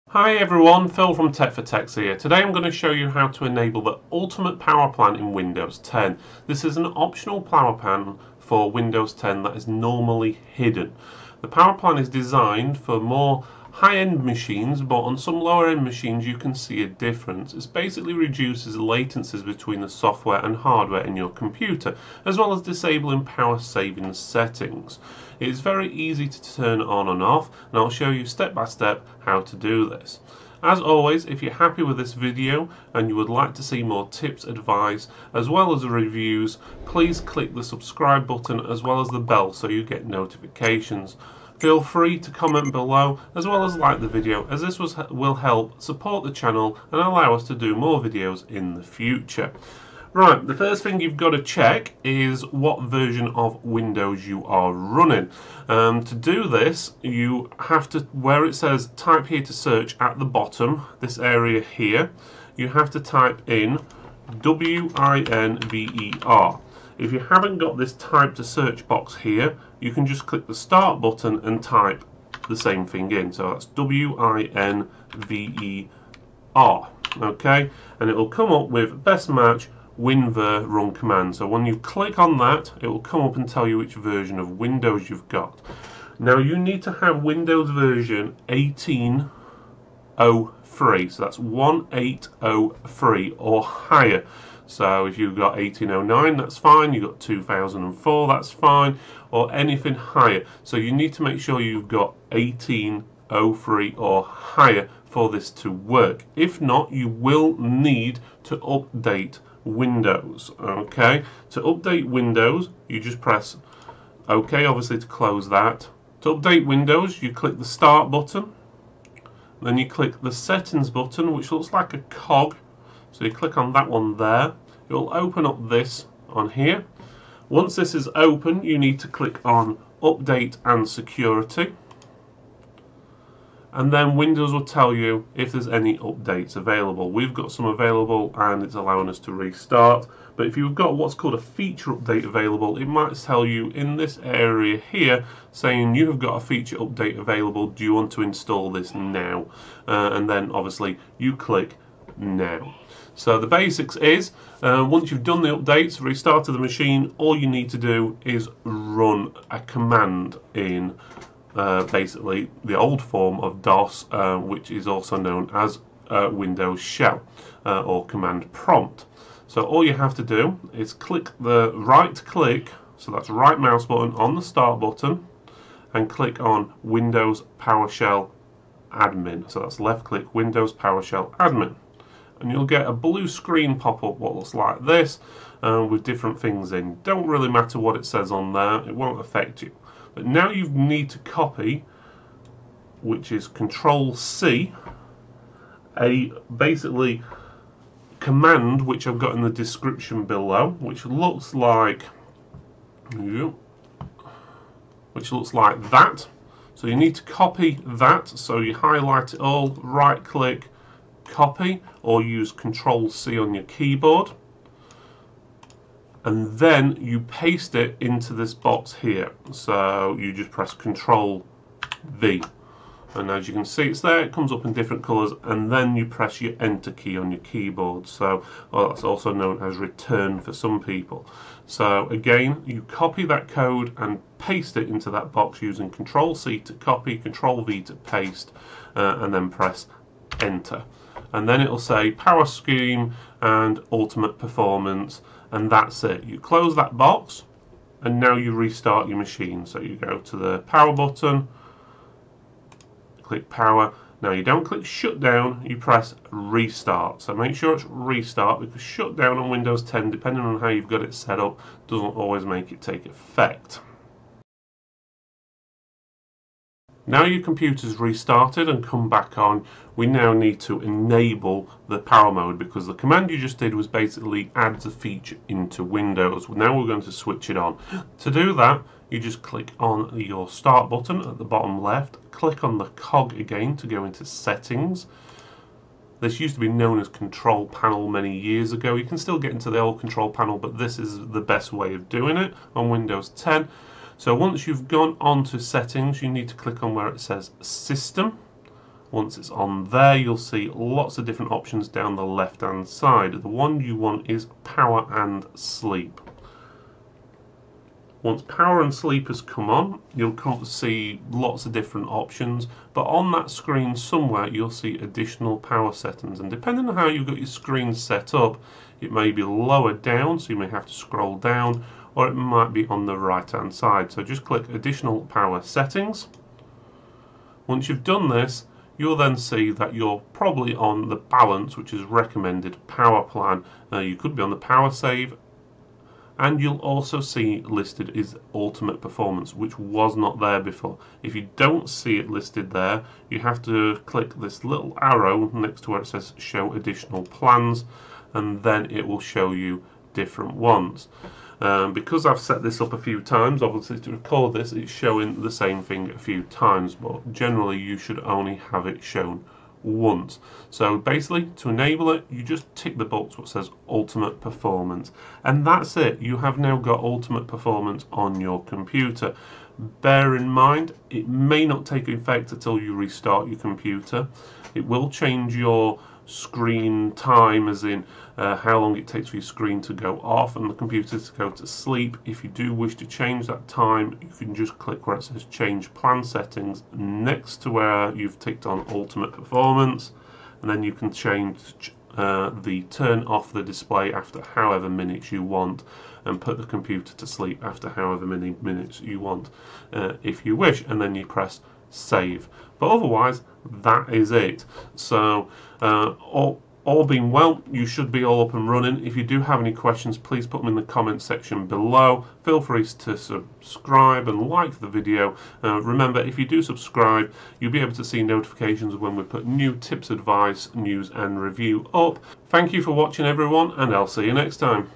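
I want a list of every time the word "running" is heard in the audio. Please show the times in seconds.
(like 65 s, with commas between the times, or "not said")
54 s, 408 s.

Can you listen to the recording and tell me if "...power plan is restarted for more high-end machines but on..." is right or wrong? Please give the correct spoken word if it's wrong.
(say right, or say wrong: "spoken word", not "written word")
wrong: "designed", not "restarted".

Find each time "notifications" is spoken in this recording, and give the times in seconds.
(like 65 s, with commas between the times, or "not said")
40 s, 418 s.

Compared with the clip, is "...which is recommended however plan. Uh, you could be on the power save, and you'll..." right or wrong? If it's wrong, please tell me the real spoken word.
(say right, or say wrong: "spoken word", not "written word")
wrong: "power", not "however".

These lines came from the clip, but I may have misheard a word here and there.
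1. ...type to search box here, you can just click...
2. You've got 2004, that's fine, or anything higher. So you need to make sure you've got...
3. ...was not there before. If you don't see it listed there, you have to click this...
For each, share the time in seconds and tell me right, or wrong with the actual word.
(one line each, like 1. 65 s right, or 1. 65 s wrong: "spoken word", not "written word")
1. 67 s right
2. 96 s right
3. 339 s right.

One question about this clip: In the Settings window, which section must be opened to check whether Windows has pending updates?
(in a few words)
Update and Security.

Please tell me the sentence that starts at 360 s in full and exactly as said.
So basically, to enable it, you just tick the box what says Ultimate Performance, and that's it.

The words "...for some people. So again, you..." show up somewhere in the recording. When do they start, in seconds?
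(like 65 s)
230 s.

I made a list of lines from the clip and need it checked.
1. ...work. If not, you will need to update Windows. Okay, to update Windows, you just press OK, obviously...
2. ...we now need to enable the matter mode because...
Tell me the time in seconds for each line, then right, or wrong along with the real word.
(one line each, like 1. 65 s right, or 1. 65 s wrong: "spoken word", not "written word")
1. 105 s right
2. 269 s wrong: "power", not "matter".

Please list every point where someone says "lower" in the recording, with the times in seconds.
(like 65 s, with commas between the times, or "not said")
15 s, 319 s.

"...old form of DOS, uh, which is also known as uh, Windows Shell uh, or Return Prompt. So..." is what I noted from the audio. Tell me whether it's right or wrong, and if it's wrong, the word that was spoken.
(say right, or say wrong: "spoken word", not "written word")
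wrong: "Command", not "Return".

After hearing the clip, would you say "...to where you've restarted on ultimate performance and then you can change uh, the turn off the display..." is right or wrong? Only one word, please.
wrong.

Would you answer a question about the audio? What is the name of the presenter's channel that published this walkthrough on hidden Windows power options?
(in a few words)
Tech for Techs.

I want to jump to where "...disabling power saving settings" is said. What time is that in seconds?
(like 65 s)
22 s.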